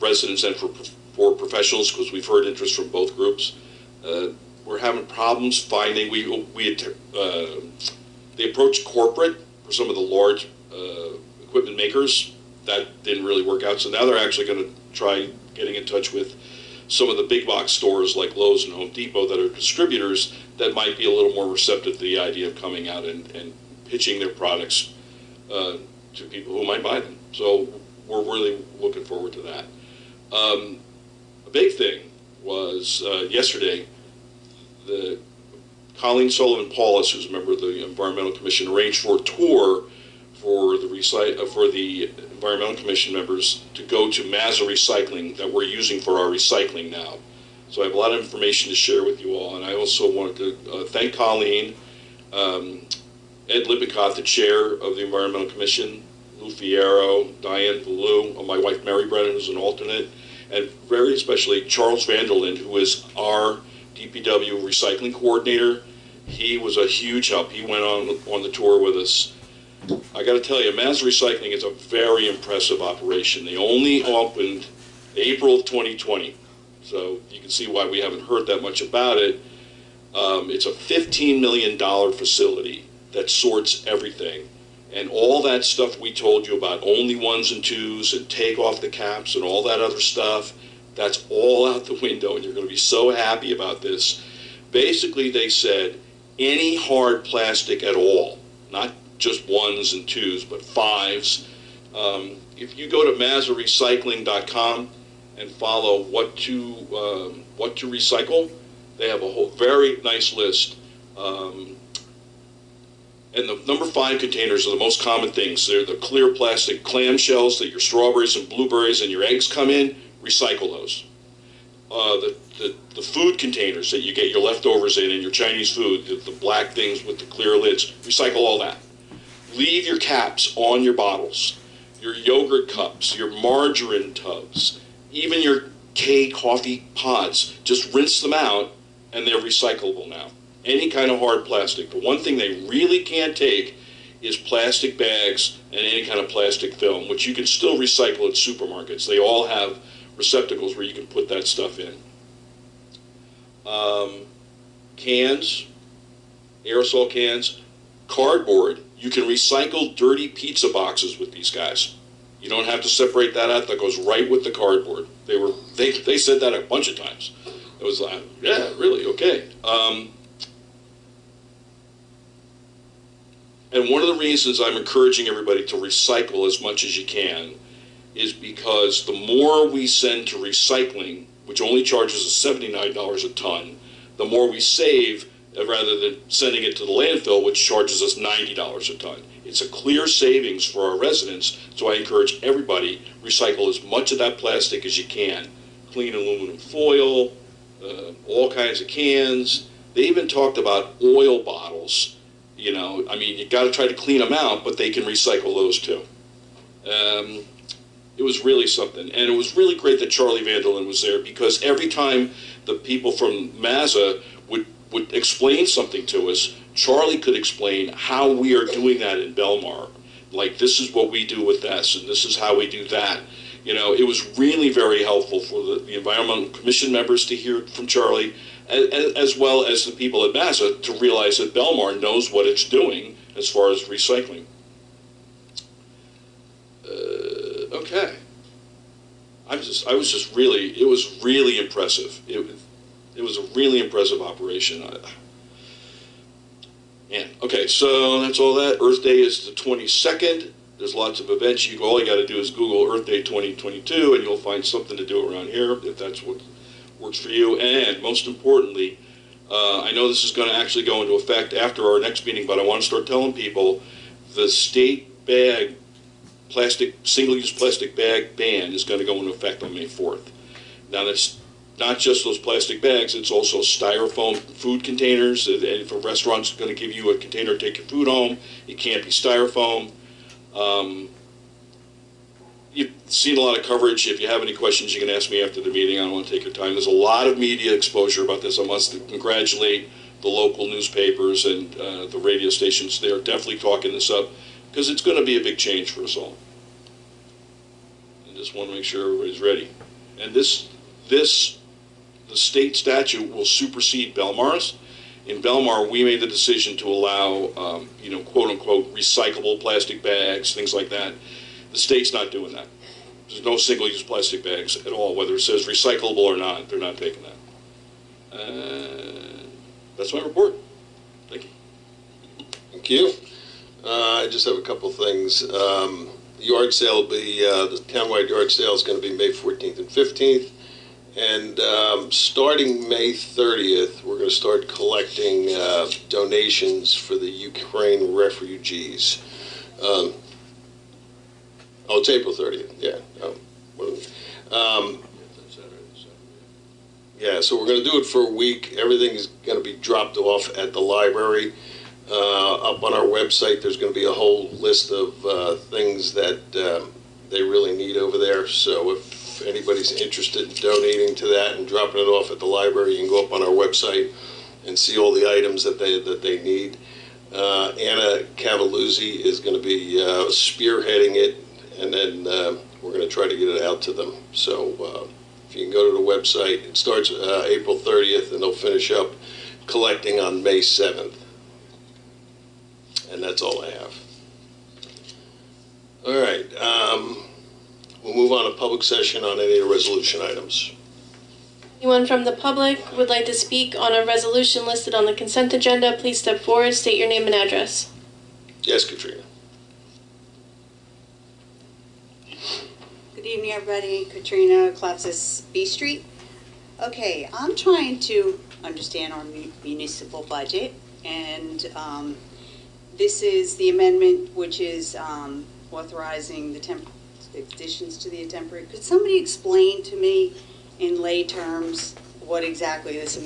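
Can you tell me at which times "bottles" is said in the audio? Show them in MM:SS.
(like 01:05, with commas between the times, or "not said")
02:10, 03:21.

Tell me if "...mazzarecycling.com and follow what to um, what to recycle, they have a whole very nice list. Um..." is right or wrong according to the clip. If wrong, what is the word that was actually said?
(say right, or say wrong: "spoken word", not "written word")
right.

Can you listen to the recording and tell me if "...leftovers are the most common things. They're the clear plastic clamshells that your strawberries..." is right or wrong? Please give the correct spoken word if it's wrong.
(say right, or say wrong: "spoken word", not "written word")
wrong: "containers", not "leftovers".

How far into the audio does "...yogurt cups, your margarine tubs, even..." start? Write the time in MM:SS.
02:12.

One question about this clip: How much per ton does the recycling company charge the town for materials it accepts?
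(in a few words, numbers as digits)
$79.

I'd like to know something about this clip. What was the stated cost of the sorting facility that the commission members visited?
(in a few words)
$15 million.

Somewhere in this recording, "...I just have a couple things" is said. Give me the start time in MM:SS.
05:24.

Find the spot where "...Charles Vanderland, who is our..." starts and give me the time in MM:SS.
01:01.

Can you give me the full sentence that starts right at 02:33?
Um, cans, aerosol cans, cardboard you can recycle dirty pizza boxes with these guys.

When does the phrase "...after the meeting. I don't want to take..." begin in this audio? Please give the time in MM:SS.
04:45.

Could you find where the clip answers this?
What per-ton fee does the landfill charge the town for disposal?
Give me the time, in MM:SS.
03:08.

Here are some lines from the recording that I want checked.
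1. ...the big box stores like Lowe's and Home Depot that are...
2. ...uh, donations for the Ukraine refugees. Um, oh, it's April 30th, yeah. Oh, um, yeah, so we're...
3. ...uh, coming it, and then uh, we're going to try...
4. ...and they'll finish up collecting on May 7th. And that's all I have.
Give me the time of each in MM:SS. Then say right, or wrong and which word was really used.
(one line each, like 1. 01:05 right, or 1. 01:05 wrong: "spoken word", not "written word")
1. 00:17 right
2. 05:35 right
3. 06:10 wrong: "spearheading", not "coming"
4. 06:18 right.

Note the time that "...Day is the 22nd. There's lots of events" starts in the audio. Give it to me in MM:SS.
04:09.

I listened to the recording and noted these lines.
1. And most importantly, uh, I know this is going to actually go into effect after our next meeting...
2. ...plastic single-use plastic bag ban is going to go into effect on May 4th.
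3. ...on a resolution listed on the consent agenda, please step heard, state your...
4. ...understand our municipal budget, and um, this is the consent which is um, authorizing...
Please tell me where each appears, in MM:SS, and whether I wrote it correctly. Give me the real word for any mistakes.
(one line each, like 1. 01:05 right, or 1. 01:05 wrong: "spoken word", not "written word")
1. 04:17 right
2. 04:26 right
3. 06:33 wrong: "forward", not "heard"
4. 06:48 wrong: "amendment", not "consent".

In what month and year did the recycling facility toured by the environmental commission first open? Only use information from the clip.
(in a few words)
April 2020.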